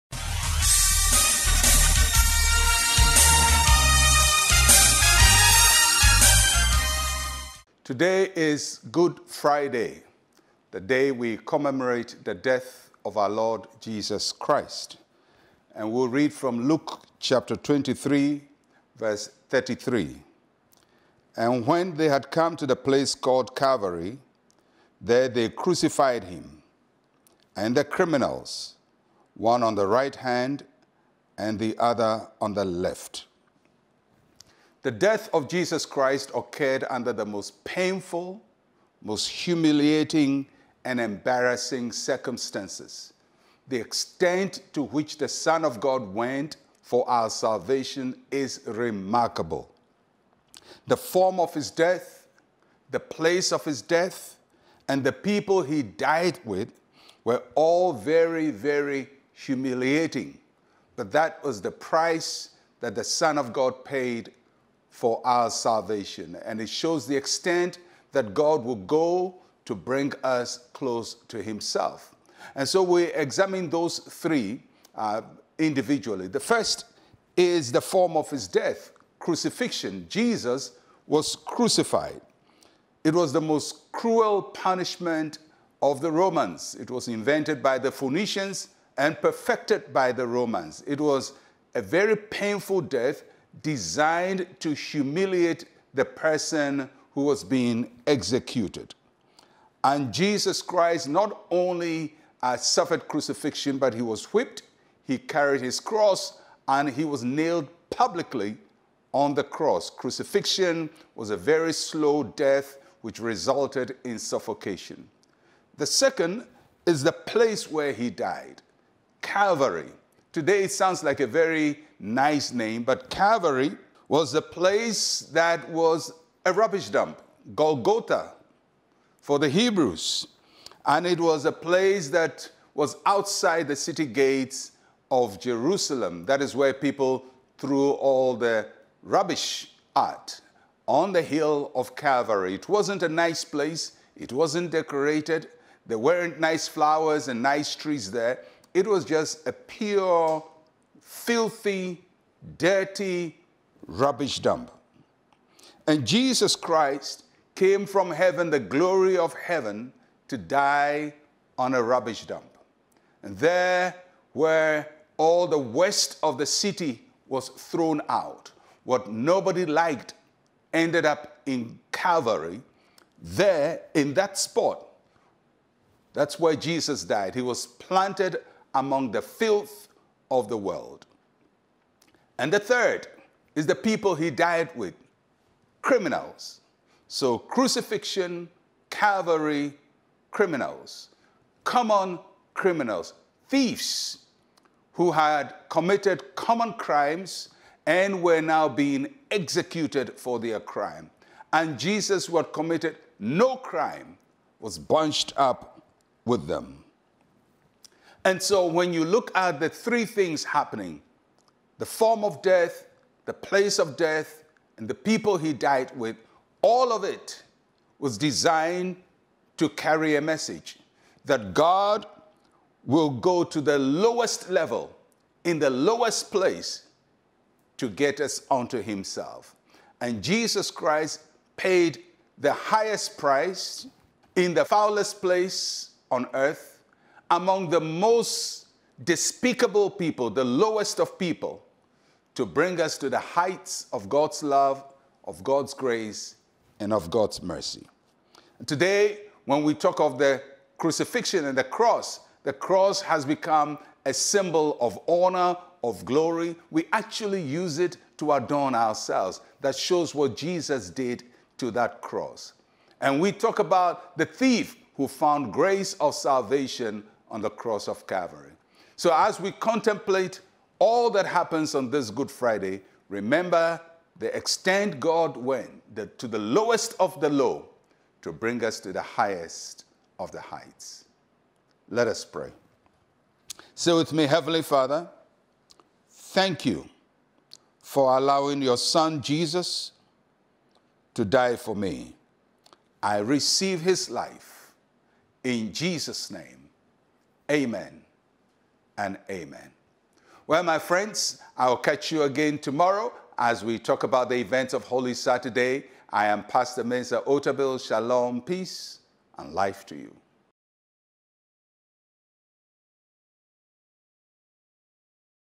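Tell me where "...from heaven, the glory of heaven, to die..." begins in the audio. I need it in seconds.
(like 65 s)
157 s.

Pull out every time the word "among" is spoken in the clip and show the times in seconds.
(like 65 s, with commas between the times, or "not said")
178 s, 237 s.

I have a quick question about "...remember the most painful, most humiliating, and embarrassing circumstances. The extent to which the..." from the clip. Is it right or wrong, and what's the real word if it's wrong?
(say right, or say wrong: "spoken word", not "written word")
wrong: "under", not "remember".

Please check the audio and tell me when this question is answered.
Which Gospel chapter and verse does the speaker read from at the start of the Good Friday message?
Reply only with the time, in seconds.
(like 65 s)
16 s.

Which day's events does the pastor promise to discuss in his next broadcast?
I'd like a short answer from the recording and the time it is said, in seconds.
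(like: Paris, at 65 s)
Holy Saturday, at 304 s.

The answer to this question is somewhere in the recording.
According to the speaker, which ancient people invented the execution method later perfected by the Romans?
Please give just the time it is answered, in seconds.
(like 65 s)
87 s.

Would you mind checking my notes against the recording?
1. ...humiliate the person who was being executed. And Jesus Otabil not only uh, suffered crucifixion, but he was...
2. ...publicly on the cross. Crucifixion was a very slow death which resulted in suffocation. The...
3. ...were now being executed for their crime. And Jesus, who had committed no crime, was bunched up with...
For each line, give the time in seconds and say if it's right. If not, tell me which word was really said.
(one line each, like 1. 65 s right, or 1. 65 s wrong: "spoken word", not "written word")
1. 94 s wrong: "Christ", not "Otabil"
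2. 107 s right
3. 198 s right.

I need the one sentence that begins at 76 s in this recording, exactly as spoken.
The first is the form of His death crucifixion.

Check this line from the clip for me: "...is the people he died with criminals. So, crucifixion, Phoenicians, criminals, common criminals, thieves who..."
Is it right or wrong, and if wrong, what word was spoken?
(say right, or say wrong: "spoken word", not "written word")
wrong: "Calvary", not "Phoenicians".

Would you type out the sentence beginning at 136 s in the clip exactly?
That is where people threw all the rubbish at on the hill of Calvary.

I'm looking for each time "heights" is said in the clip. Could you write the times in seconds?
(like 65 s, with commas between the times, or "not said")
243 s, 280 s.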